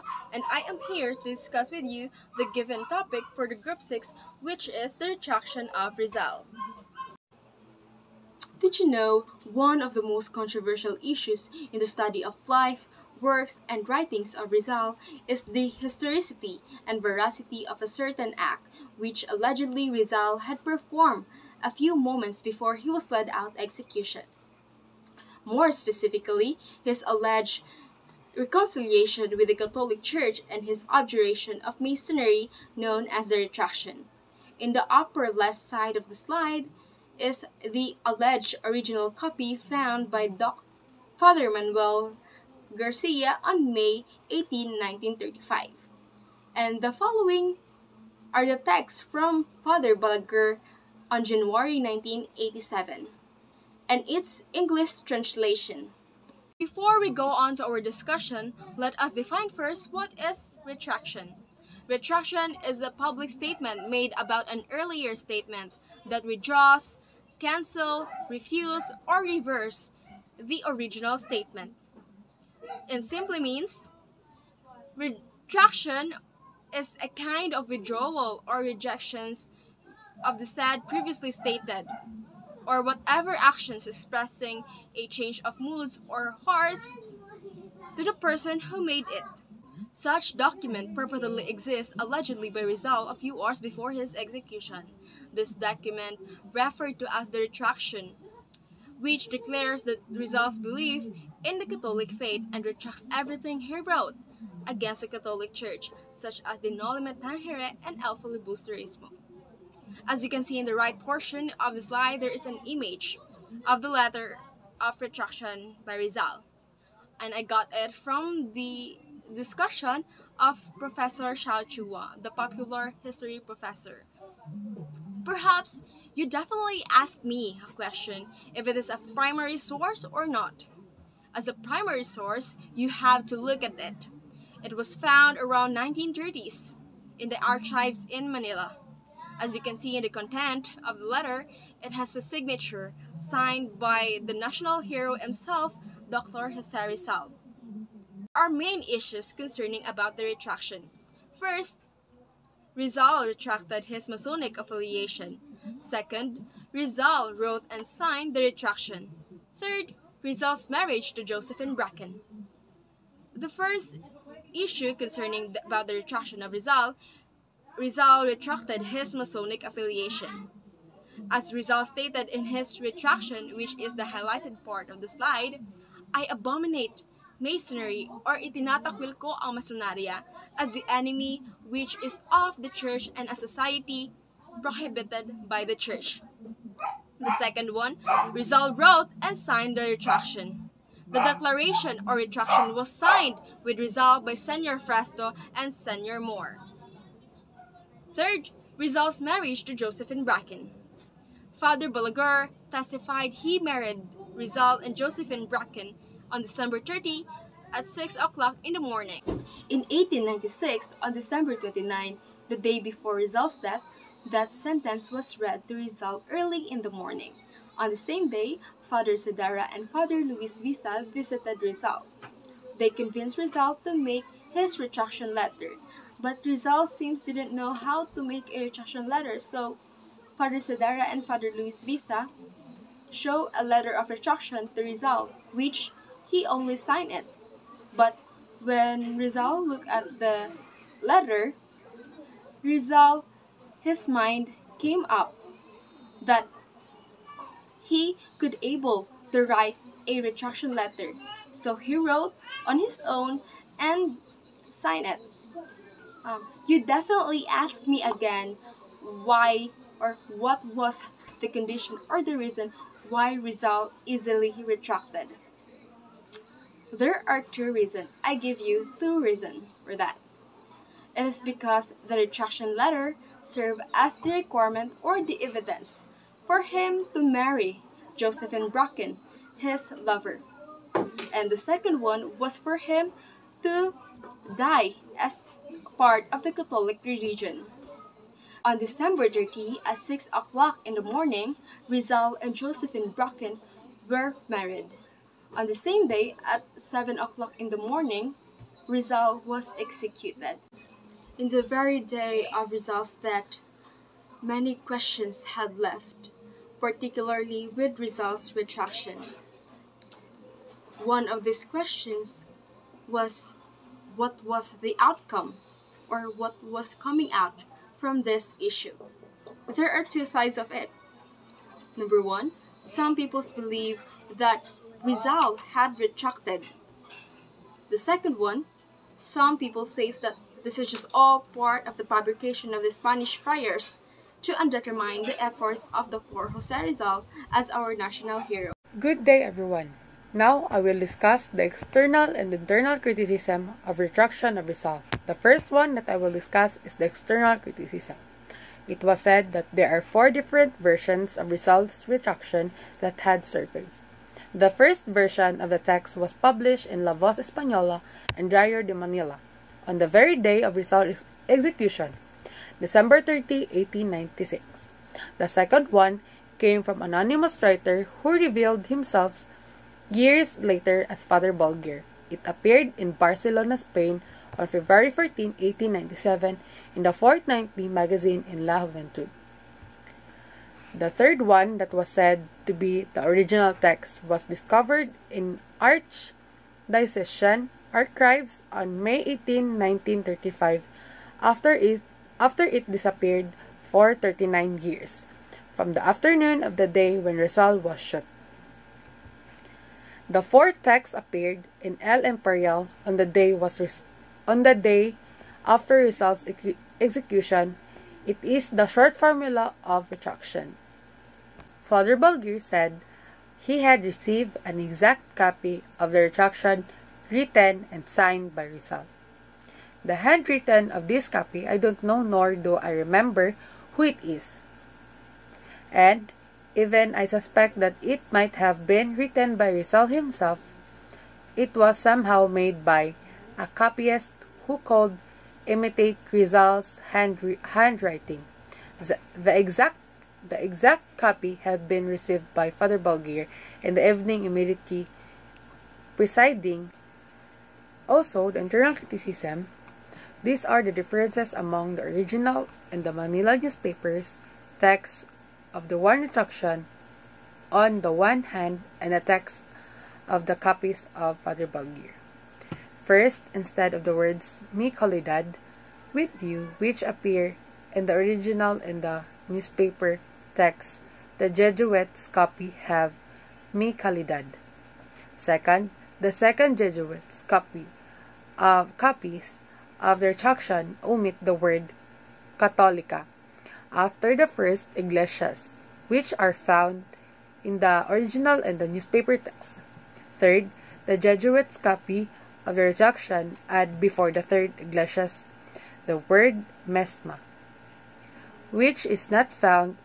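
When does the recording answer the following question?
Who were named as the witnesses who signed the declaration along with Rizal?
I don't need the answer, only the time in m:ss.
3:14.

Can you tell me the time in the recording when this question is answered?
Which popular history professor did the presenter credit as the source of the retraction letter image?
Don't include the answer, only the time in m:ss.
2:01.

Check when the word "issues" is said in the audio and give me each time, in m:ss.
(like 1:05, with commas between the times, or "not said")
0:11, 2:28, 2:44, 5:18.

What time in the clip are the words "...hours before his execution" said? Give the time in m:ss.
1:33.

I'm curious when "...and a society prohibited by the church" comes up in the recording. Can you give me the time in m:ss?
3:03.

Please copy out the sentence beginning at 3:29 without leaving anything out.
In 1896, on December 29, the day before Rizal's death, that sentence was read to Rizal early in the morning.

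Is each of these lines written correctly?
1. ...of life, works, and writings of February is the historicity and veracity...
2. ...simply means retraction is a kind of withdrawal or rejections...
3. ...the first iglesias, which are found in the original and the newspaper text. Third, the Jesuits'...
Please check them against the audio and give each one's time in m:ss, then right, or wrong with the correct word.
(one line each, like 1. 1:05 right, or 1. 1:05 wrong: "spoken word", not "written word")
1. 0:12 wrong: "Rizal", not "February"
2. 1:13 right
3. 8:04 right.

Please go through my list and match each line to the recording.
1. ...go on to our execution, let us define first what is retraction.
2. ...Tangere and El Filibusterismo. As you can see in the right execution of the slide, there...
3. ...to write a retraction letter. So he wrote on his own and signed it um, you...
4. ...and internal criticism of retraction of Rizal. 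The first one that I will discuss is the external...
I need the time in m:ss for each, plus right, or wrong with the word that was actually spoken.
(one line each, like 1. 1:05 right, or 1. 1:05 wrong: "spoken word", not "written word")
1. 0:57 wrong: "discussion", not "execution"
2. 1:47 wrong: "portion", not "execution"
3. 4:09 right
4. 5:42 right.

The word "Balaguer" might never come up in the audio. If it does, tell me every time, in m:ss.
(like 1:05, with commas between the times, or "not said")
0:49, 3:21, 6:11, 6:52, 7:22, 7:41.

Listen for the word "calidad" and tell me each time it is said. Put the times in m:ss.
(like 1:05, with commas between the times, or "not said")
7:44, 7:53.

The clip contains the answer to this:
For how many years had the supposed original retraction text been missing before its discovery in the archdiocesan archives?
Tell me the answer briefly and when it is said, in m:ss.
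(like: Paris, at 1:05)
39, at 6:34.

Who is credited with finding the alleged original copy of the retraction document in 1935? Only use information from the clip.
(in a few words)
Father Manuel Garcia.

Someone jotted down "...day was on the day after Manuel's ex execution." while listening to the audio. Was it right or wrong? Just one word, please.
wrong.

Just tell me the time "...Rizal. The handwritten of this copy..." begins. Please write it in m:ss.
6:58.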